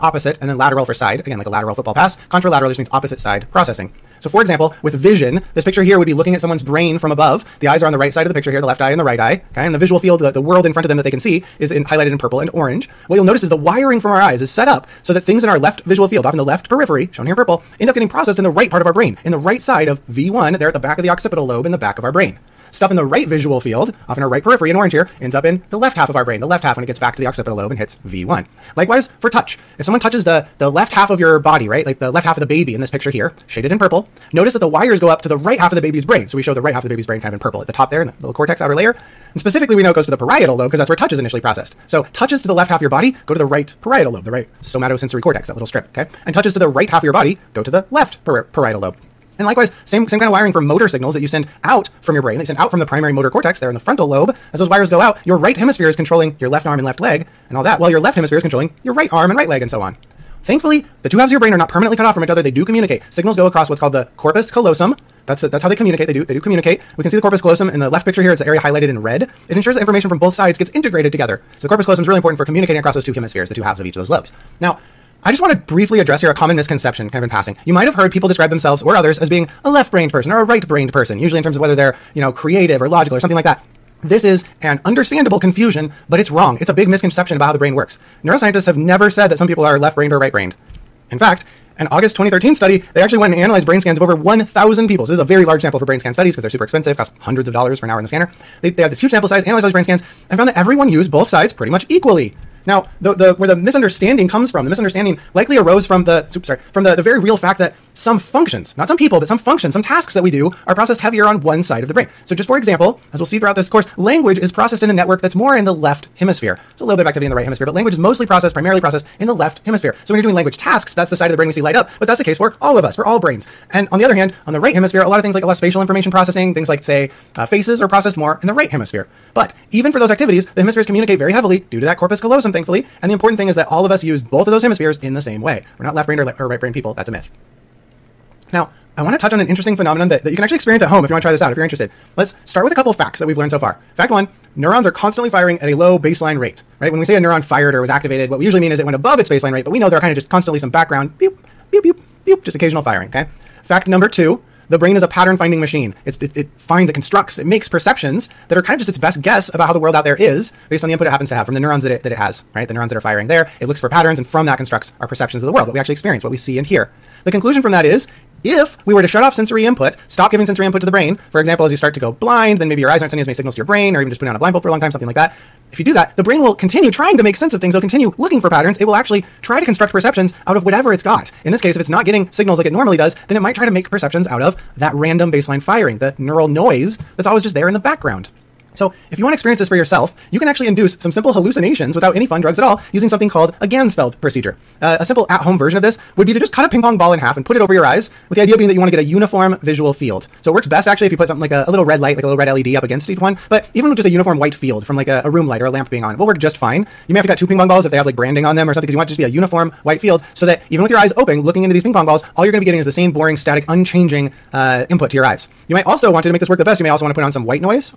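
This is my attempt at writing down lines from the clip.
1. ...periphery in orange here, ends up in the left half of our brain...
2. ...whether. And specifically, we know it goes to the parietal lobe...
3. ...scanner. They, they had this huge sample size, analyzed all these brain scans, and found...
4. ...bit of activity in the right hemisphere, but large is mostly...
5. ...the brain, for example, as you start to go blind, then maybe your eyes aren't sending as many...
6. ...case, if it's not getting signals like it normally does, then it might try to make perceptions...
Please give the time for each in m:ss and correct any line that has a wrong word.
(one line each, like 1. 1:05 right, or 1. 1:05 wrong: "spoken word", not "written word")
1. 0:24 right
2. 0:38 wrong: "layer", not "whether"
3. 1:38 right
4. 1:56 wrong: "language", not "large"
5. 2:50 right
6. 3:01 right.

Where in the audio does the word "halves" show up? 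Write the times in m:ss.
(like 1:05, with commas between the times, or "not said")
1:01, 1:13.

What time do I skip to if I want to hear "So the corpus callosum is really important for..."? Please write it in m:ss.
1:11.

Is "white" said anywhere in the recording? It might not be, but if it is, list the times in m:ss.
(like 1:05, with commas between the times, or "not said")
3:24, 3:29, 3:37.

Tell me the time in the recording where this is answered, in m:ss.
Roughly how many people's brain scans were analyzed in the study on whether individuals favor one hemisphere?
1:34.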